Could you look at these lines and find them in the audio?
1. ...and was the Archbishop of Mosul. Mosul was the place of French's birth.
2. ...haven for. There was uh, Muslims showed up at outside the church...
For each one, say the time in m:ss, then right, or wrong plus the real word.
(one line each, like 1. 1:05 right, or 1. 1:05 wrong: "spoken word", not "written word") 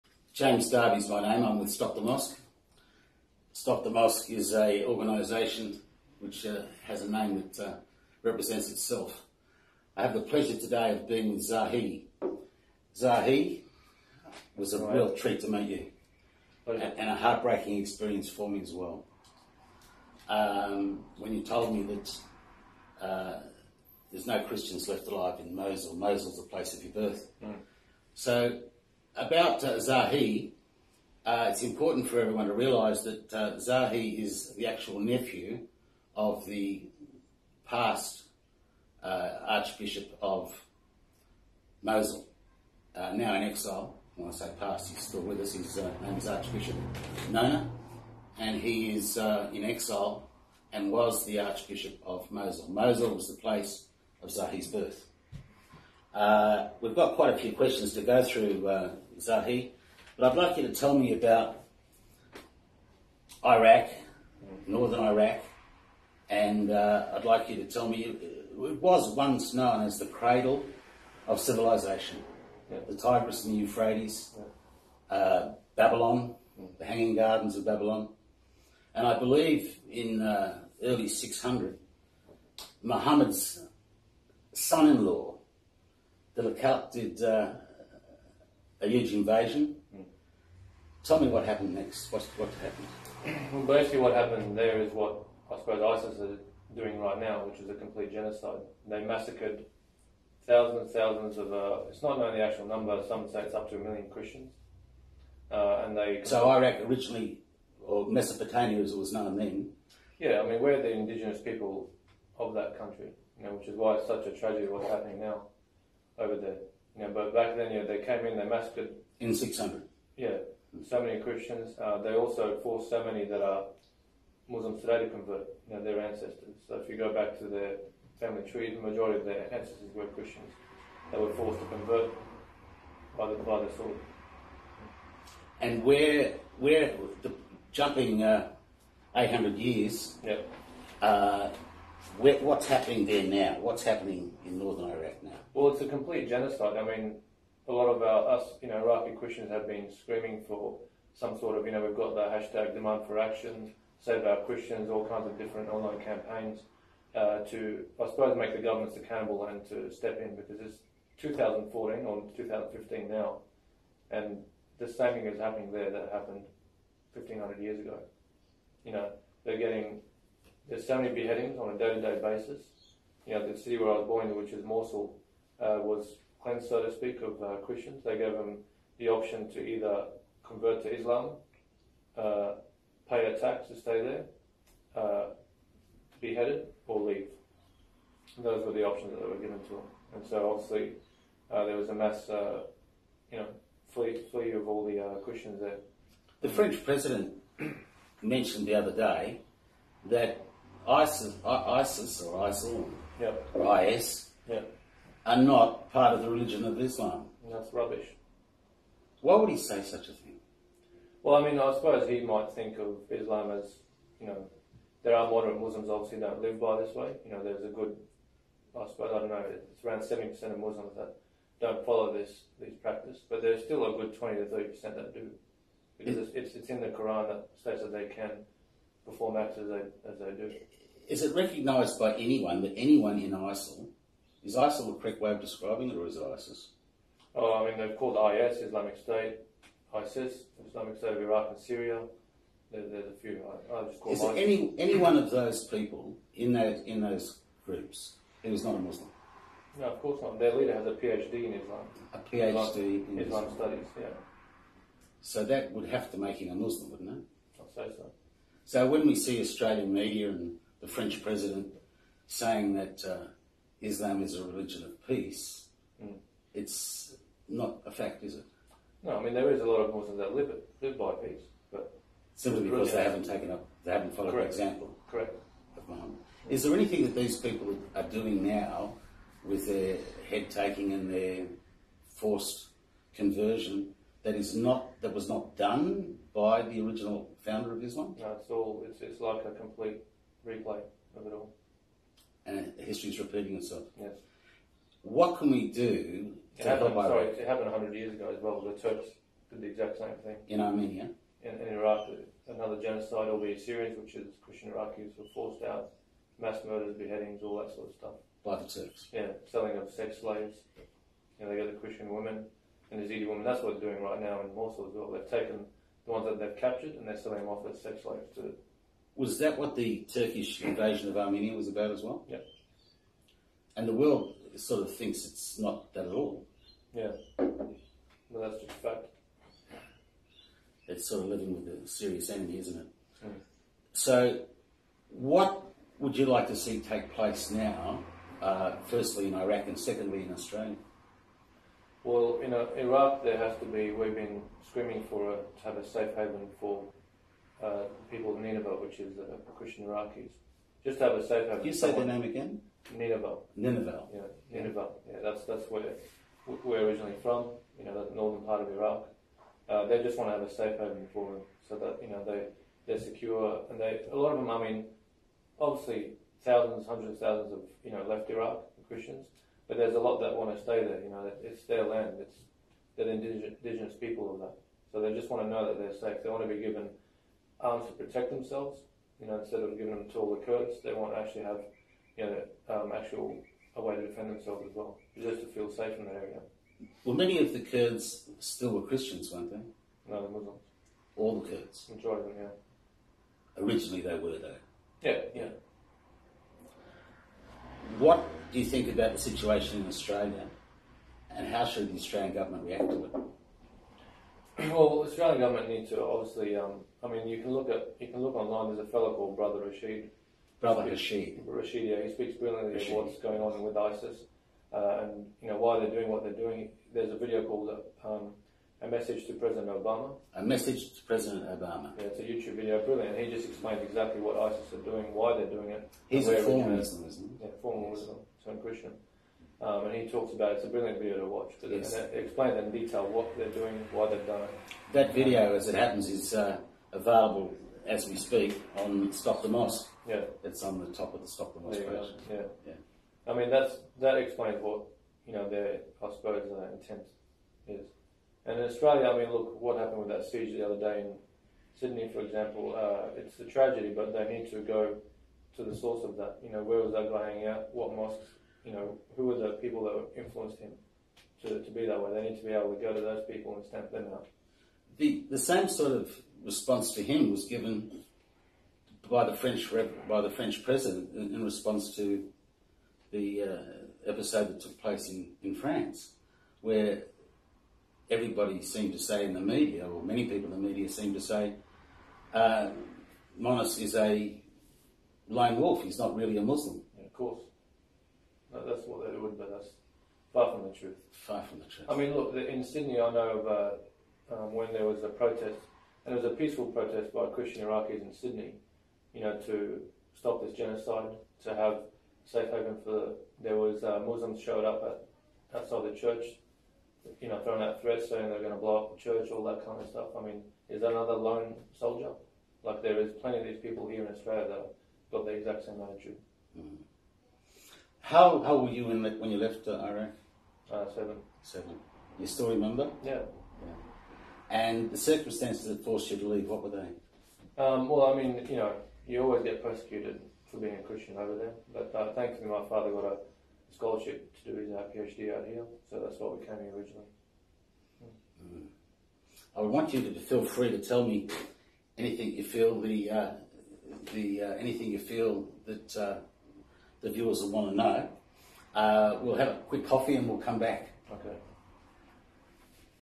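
1. 0:50 wrong: "Zahee", not "French"
2. 8:22 right.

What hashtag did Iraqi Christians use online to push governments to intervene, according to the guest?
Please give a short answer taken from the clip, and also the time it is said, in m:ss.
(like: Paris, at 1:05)
demand for action, at 2:32.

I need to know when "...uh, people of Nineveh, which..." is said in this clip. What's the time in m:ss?
5:47.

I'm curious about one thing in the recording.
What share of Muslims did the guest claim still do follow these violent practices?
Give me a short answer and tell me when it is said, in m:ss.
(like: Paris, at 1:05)
20 to 30%, at 3:44.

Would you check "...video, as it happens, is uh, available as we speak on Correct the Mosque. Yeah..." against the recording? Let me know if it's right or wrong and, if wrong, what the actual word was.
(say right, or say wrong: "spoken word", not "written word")
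wrong: "Stop", not "Correct".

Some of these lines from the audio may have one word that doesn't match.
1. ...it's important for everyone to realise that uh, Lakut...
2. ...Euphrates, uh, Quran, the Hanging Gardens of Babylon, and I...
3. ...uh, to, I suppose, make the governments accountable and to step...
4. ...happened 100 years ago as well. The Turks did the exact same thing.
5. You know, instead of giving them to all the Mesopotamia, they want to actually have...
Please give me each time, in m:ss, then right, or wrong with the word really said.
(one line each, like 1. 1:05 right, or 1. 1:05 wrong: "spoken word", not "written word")
1. 0:31 wrong: "Zahee", not "Lakut"
2. 1:13 wrong: "Babylon", not "Quran"
3. 2:37 right
4. 4:57 right
5. 6:19 wrong: "Kurds", not "Mesopotamia".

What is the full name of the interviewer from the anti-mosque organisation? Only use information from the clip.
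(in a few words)
James Darby.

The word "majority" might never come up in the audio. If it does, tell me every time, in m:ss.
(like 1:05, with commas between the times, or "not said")
2:08, 6:31.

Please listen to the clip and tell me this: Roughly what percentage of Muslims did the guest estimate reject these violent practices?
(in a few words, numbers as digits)
70%.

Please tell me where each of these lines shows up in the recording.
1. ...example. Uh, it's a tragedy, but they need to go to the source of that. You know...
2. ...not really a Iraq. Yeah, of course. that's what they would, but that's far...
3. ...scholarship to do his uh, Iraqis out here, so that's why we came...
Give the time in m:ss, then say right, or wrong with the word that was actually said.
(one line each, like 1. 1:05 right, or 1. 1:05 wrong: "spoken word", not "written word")
1. 7:32 right
2. 8:05 wrong: "Muslim", not "Iraq"
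3. 8:53 wrong: "PhD", not "Iraqis".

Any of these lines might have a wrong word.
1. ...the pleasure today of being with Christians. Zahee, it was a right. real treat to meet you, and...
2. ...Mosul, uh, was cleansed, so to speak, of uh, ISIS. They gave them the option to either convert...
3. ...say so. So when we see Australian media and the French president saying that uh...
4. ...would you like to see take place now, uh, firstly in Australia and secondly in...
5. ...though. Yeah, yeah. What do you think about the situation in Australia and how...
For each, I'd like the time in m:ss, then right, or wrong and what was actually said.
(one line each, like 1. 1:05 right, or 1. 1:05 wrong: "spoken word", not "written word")
1. 0:10 wrong: "Zahee", not "Christians"
2. 2:54 wrong: "Christians", not "ISIS"
3. 4:17 right
4. 5:35 wrong: "Iraq", not "Australia"
5. 6:34 right.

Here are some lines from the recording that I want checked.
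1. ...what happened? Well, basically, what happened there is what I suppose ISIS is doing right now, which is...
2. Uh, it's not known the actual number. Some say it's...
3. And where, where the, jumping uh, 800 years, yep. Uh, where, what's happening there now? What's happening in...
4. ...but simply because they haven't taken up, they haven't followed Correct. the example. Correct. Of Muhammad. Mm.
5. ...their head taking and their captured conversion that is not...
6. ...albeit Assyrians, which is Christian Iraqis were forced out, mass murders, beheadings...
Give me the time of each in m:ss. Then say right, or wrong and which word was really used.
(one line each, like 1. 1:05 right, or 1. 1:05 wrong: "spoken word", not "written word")
1. 1:32 right
2. 1:41 right
3. 2:15 right
4. 4:31 right
5. 4:39 wrong: "forced", not "captured"
6. 5:03 right.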